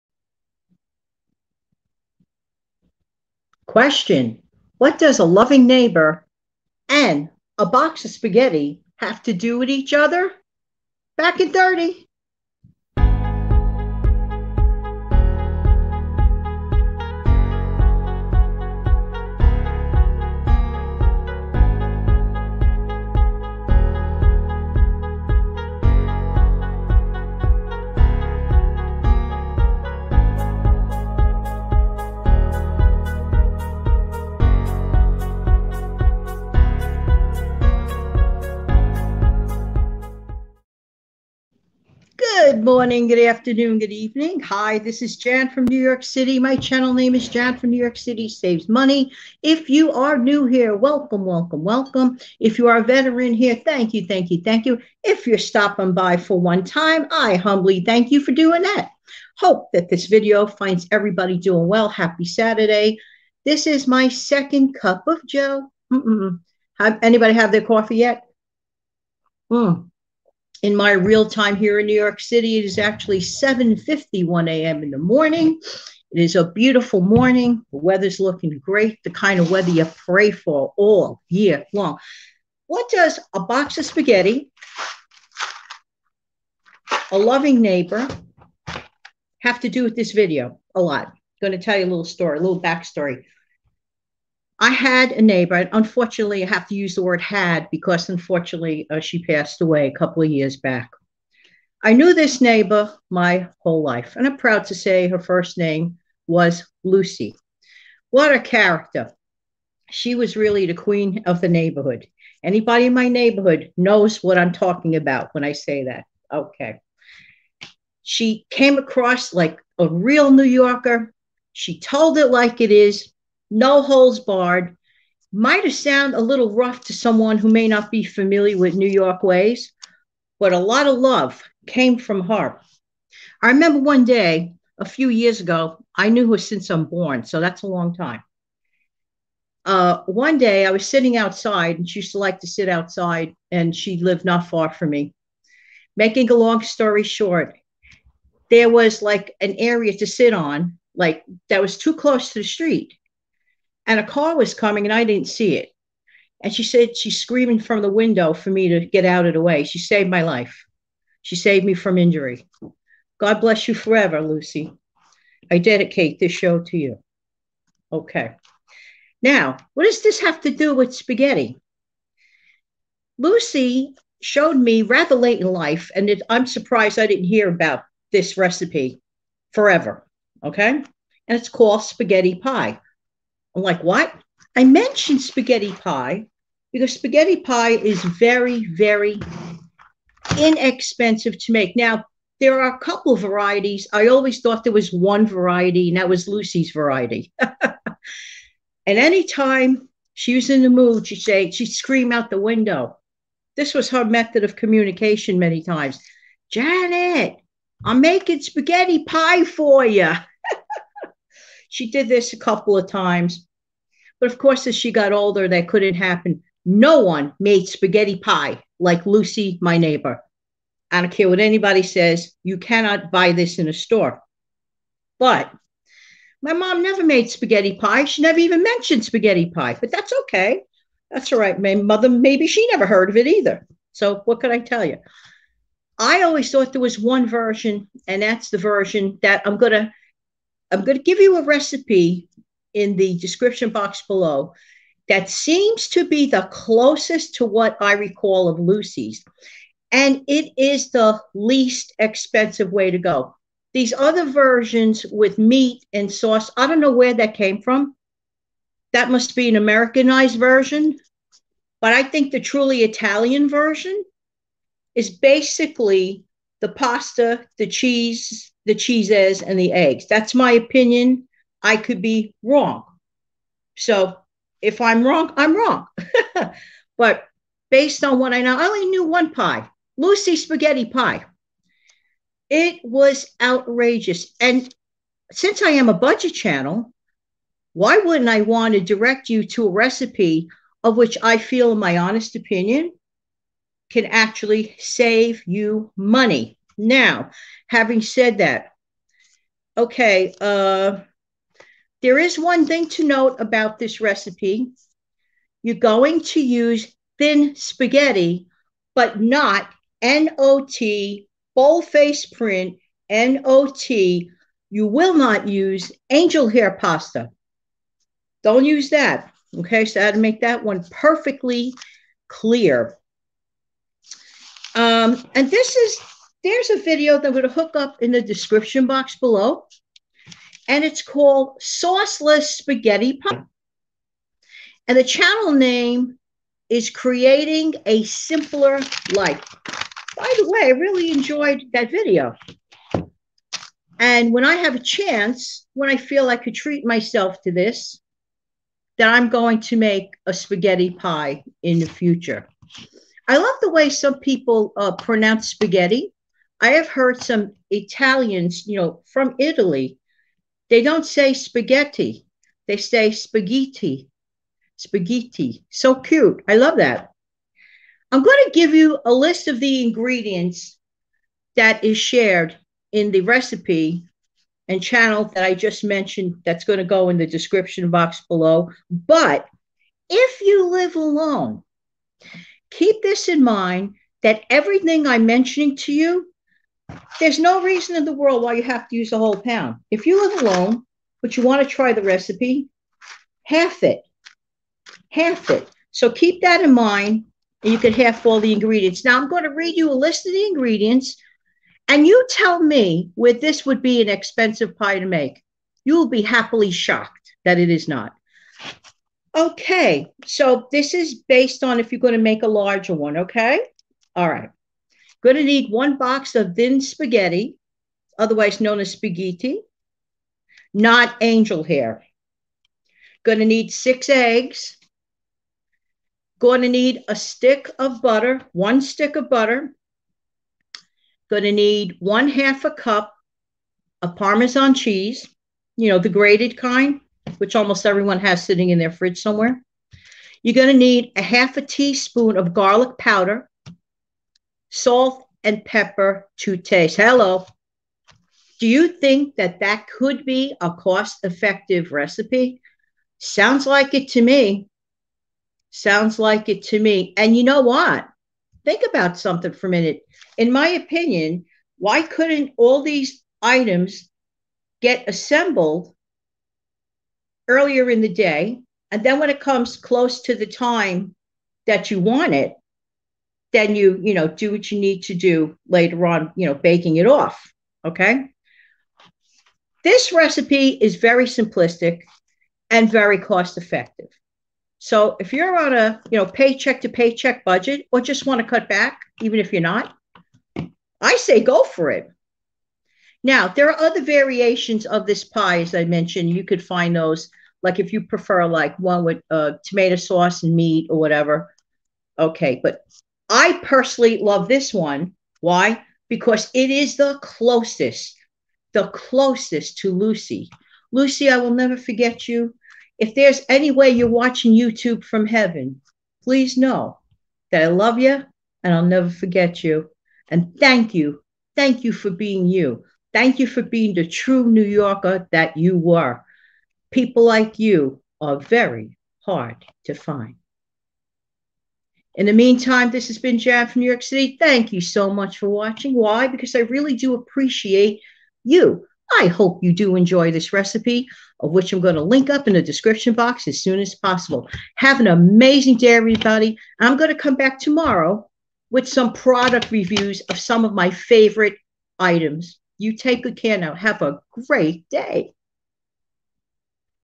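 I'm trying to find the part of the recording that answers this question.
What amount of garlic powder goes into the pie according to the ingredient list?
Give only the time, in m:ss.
7:21.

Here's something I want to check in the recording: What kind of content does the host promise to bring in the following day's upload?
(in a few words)
Product reviews.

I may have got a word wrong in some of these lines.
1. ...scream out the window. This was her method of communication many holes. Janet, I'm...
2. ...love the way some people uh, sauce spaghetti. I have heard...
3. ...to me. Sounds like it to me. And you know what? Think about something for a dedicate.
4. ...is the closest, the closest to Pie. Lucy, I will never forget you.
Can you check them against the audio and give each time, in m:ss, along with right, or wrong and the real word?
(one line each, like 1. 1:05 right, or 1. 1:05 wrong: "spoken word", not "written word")
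1. 3:21 wrong: "times", not "holes"
2. 5:53 wrong: "pronounce", not "sauce"
3. 7:34 wrong: "minute", not "dedicate"
4. 8:26 wrong: "Lucy", not "Pie".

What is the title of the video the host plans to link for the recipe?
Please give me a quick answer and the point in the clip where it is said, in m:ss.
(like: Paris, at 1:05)
Sauceless Spaghetti Pie, at 5:31.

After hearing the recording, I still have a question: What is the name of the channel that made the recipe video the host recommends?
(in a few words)
Creating a Simpler Life.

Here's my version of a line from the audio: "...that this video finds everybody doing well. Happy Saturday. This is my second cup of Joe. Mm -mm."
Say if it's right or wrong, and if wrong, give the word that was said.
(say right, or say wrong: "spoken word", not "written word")
right.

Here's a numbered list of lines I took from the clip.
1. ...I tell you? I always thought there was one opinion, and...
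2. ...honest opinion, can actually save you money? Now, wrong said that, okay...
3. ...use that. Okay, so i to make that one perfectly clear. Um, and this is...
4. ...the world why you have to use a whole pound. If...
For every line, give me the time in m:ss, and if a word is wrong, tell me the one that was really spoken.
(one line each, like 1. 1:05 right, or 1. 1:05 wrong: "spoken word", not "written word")
1. 3:54 wrong: "version", not "opinion"
2. 4:51 wrong: "having", not "wrong"
3. 5:18 right
4. 6:28 right.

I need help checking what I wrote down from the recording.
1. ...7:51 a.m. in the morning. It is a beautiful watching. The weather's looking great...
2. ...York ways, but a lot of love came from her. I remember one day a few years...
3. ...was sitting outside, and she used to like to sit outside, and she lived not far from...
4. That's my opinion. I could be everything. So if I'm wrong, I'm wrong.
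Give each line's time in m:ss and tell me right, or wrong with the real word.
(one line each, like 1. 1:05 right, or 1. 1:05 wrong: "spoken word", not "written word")
1. 1:13 wrong: "morning", not "watching"
2. 2:08 right
3. 2:20 right
4. 4:30 wrong: "wrong", not "everything".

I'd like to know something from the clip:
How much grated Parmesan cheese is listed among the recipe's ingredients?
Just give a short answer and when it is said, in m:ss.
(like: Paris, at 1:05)
Half a cup, at 7:11.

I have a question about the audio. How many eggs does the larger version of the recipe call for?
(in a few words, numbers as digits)
6.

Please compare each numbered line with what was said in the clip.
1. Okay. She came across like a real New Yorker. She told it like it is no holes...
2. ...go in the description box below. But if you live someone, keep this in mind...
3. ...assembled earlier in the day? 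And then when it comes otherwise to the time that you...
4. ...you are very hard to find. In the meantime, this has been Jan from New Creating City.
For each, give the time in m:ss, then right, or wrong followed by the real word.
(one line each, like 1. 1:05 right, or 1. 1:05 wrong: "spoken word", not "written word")
1. 1:56 right
2. 6:16 wrong: "alone", not "someone"
3. 7:45 wrong: "close", not "otherwise"
4. 8:47 wrong: "York", not "Creating".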